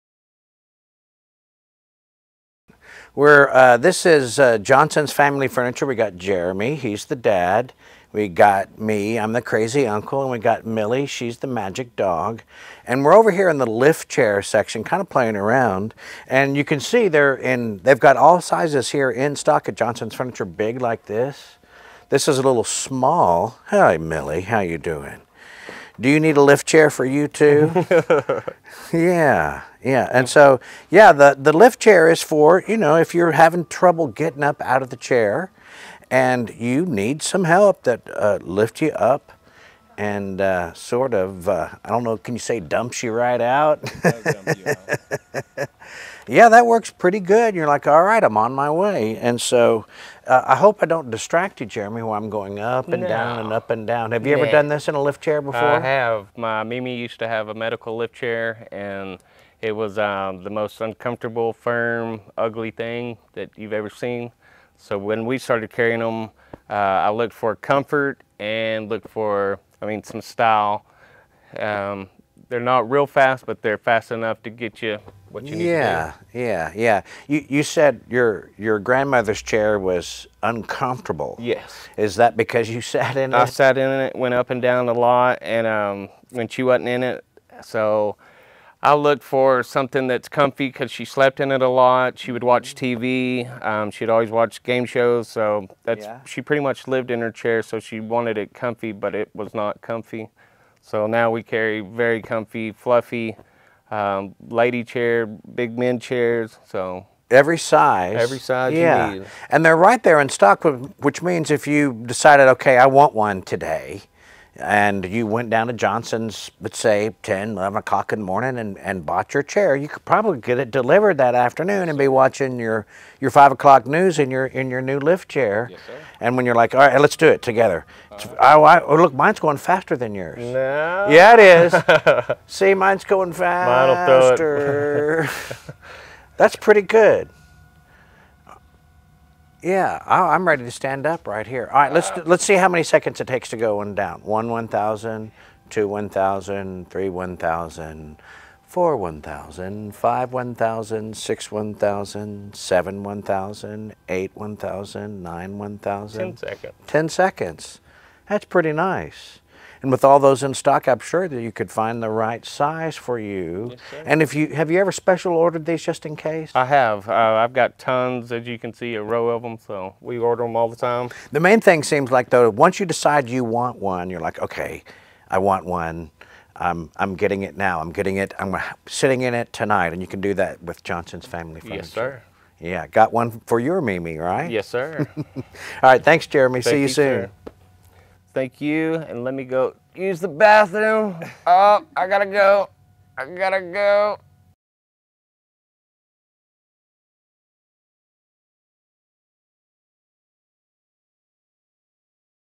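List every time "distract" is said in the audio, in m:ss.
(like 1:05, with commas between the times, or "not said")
0:51.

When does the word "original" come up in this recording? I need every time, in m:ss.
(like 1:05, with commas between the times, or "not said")
not said.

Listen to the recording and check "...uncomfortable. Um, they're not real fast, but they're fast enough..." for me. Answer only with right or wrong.
wrong.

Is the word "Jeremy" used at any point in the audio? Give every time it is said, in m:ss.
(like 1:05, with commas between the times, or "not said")
0:06, 0:51, 3:06.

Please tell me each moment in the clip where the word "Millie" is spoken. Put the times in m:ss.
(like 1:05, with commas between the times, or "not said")
0:10, 0:23.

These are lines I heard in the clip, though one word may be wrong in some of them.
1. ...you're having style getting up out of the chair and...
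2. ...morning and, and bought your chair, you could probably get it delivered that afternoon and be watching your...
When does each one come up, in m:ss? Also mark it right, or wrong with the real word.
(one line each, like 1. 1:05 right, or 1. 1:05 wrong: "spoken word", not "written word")
1. 0:33 wrong: "trouble", not "style"
2. 1:58 right.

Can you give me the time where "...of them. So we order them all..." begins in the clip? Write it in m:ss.
2:49.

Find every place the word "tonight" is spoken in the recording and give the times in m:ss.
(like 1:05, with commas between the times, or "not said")
2:59.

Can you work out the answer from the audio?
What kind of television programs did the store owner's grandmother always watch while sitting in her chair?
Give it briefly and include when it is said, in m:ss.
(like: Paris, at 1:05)
game shows, at 1:34.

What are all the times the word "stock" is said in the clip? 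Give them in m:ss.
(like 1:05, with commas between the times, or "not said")
0:19, 1:50, 2:40.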